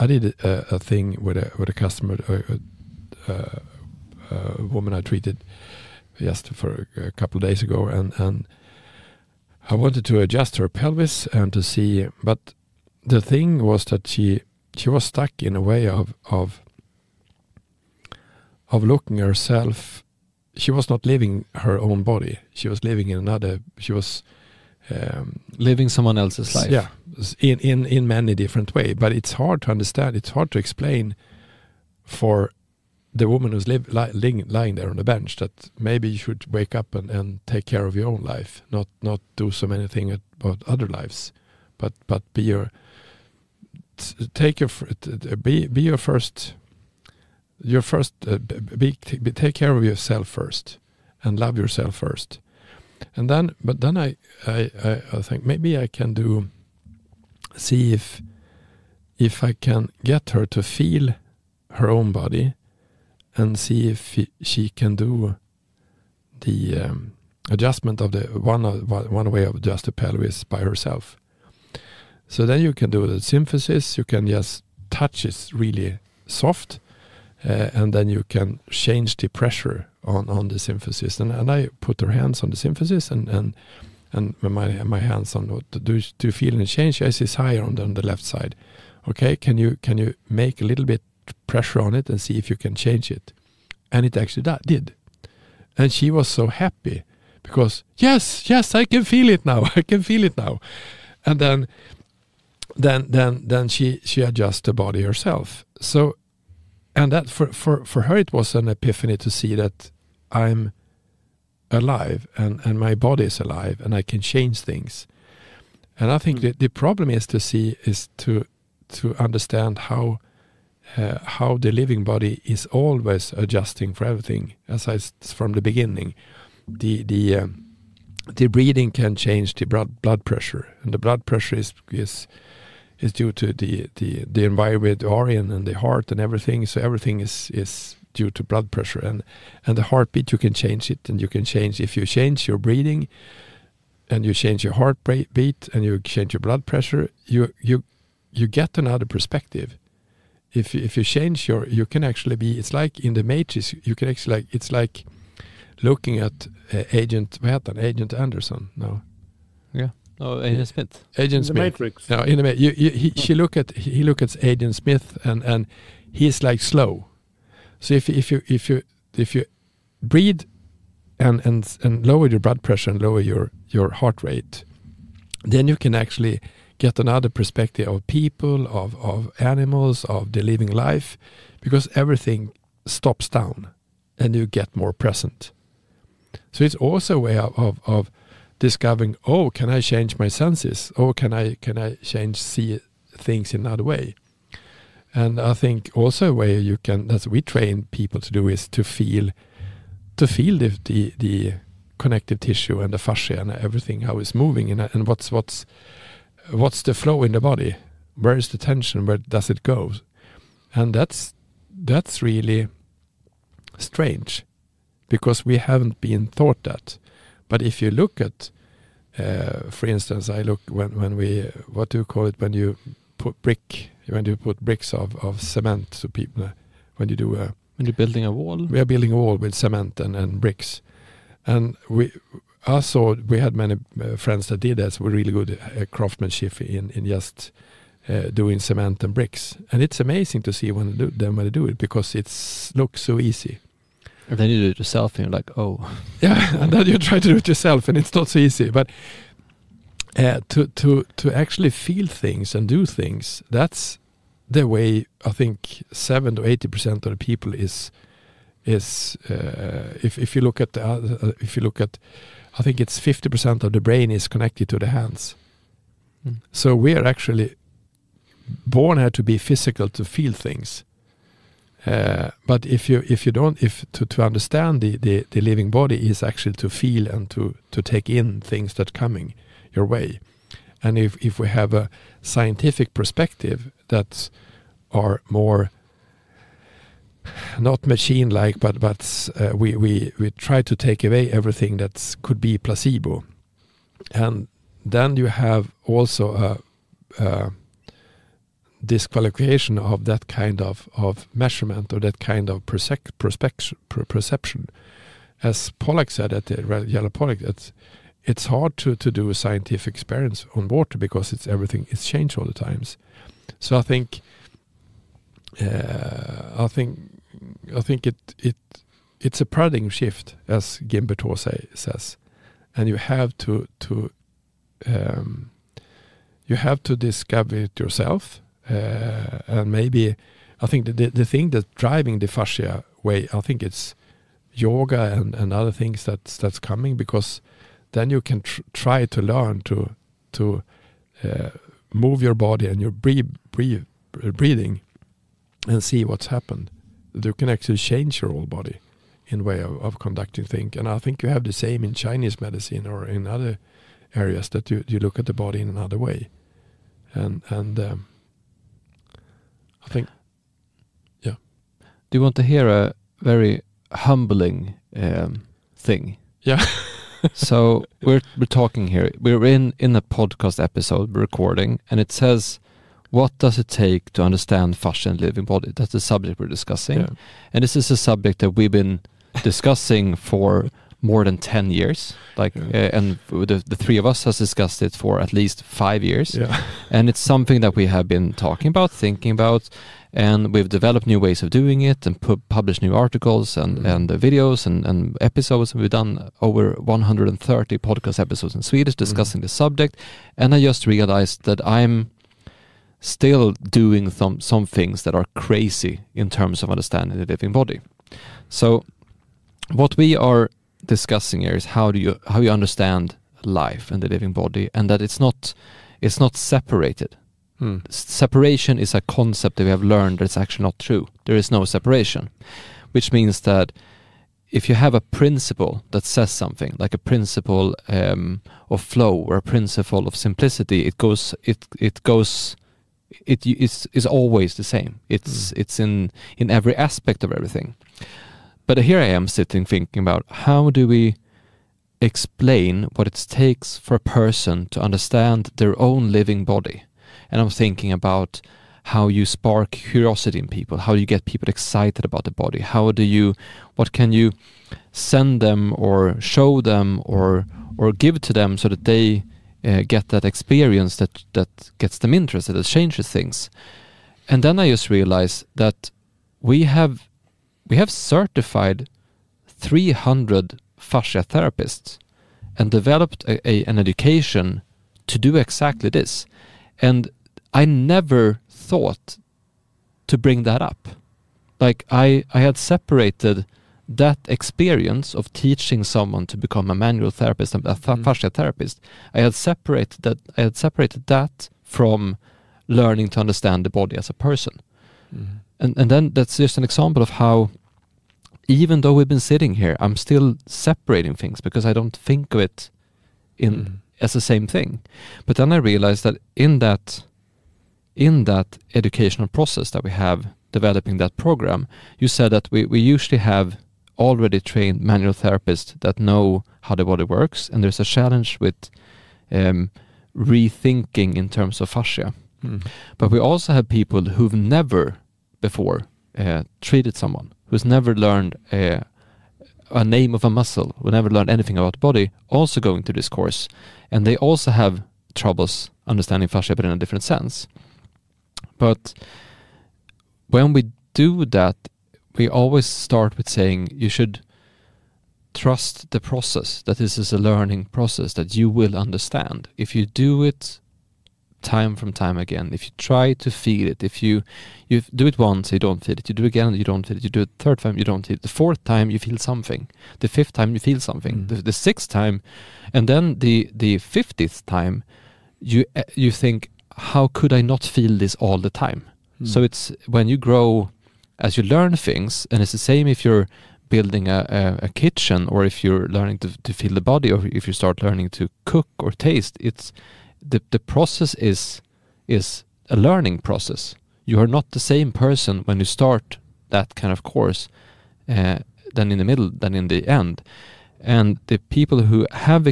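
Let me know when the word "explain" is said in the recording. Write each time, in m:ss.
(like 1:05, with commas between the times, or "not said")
0:30, 7:22.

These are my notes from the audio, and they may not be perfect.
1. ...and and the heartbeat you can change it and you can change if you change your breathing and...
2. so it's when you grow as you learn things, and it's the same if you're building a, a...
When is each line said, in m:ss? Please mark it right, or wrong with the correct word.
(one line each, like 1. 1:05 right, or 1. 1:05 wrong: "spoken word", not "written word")
1. 2:19 right
2. 9:29 right.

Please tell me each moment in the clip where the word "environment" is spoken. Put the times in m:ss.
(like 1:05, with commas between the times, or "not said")
2:14.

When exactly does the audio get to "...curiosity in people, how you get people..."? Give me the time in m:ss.
7:29.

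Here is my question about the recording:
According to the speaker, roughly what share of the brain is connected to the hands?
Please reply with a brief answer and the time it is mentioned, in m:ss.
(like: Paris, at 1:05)
50%, at 4:22.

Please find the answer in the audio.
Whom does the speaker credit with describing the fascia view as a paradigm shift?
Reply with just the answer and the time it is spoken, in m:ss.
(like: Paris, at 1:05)
Guimberteau, at 5:20.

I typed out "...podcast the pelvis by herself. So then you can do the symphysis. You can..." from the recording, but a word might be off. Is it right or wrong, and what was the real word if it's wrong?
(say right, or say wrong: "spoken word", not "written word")
wrong: "adjust", not "podcast".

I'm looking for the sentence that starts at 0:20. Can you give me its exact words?
She was not living her own body.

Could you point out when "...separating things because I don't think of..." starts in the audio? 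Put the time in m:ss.
8:20.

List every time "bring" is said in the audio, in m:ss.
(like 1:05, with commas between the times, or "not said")
8:00.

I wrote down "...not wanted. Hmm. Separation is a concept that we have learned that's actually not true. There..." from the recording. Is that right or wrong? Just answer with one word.
wrong.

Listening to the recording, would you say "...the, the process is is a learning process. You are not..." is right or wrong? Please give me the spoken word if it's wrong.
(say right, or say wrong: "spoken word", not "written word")
right.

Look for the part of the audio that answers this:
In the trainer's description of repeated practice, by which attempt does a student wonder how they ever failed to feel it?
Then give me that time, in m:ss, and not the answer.
9:23.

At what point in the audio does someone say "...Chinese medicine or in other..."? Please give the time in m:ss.
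5:51.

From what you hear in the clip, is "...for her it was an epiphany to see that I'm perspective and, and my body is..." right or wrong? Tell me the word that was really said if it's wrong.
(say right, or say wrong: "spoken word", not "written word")
wrong: "alive", not "perspective".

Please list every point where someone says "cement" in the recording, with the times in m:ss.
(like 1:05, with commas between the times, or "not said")
3:45, 3:49, 3:58.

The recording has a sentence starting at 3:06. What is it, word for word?
So it's also a way of, of, of discovering, oh, can I change my senses?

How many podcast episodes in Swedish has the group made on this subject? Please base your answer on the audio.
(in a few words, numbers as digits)
over 130.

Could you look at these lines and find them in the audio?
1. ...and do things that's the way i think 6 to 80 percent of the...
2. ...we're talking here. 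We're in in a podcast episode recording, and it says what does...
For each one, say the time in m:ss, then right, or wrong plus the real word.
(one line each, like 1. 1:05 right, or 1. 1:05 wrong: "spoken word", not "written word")
1. 4:12 wrong: "7", not "6"
2. 6:08 right.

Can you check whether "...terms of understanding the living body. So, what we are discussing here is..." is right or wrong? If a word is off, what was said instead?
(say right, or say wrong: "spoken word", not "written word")
right.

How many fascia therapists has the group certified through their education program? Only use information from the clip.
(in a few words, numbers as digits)
300.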